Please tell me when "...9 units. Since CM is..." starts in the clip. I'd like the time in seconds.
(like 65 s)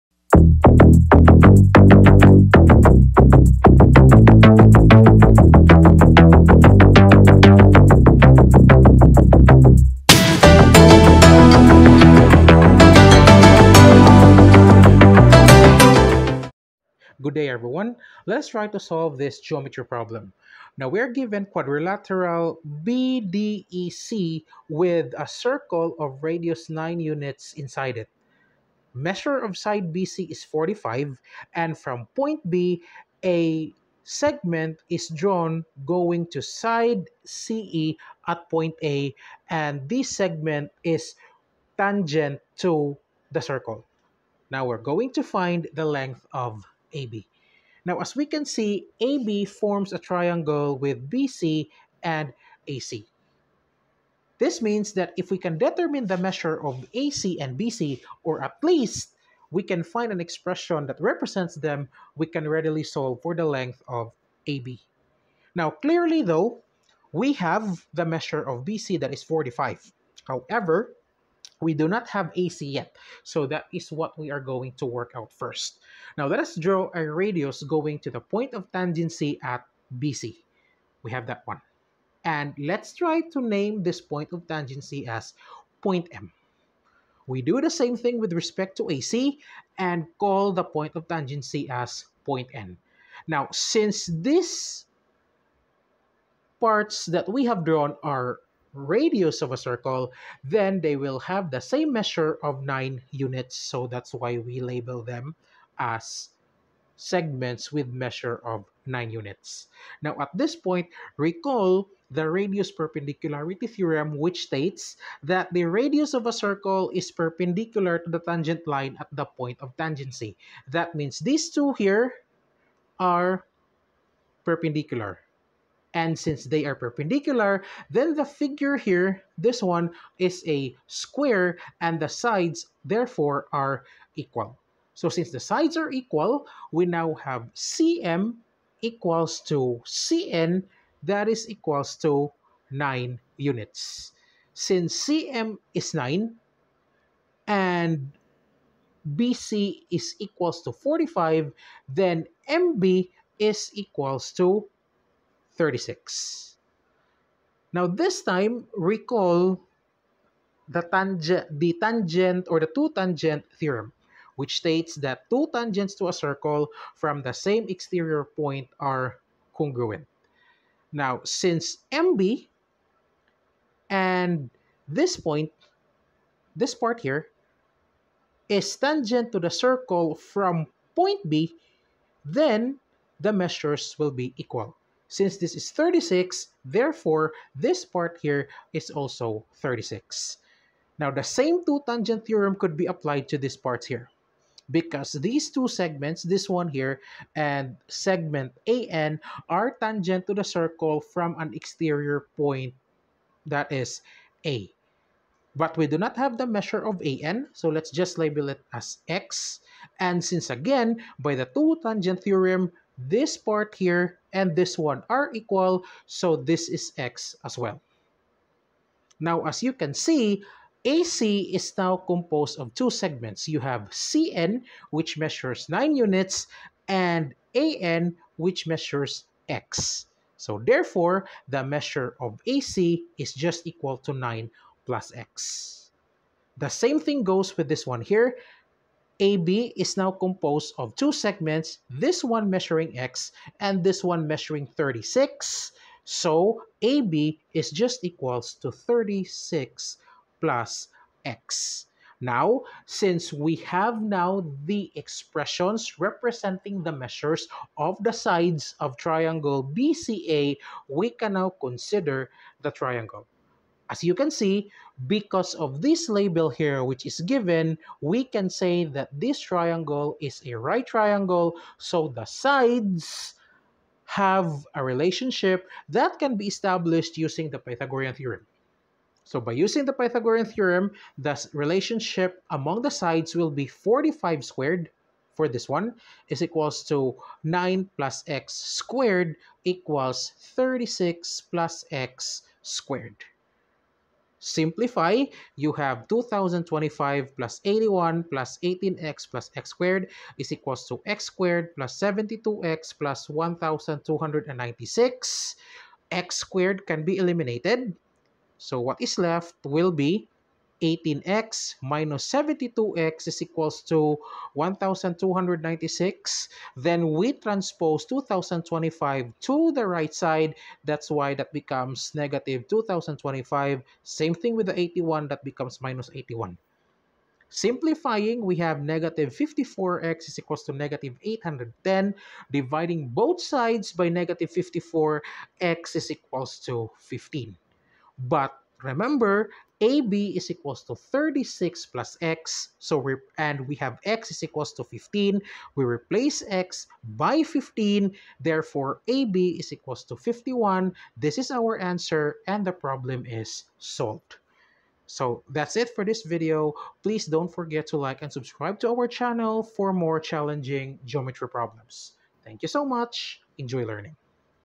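142 s.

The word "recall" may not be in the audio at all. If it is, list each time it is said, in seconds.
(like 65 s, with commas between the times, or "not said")
111 s, 158 s.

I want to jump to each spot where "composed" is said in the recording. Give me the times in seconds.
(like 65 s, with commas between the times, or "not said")
221 s, 240 s.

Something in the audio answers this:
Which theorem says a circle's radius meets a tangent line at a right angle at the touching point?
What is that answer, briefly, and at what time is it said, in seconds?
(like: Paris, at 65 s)
radius perpendicularity theorem, at 112 s.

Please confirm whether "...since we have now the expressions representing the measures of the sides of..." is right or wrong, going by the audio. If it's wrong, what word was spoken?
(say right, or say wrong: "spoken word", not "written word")
right.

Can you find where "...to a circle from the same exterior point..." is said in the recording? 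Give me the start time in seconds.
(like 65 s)
166 s.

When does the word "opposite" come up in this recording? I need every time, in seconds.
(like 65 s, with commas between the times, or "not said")
not said.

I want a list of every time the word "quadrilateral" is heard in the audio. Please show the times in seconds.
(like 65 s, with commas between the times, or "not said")
21 s.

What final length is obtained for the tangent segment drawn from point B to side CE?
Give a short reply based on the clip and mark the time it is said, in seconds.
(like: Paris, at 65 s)
51, at 349 s.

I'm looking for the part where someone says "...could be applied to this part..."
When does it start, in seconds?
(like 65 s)
192 s.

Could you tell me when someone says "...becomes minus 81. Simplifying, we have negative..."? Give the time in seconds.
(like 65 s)
325 s.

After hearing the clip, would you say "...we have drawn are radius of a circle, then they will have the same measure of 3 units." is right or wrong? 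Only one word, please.
wrong.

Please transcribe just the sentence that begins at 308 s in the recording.
So what is left will be 18x minus 72x is equals to 1,296.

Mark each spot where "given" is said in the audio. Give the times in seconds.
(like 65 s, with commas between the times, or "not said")
21 s, 267 s.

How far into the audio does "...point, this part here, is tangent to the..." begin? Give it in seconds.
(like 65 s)
175 s.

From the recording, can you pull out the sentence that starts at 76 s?
Now let us draw a radius going to the point of tangency at BC.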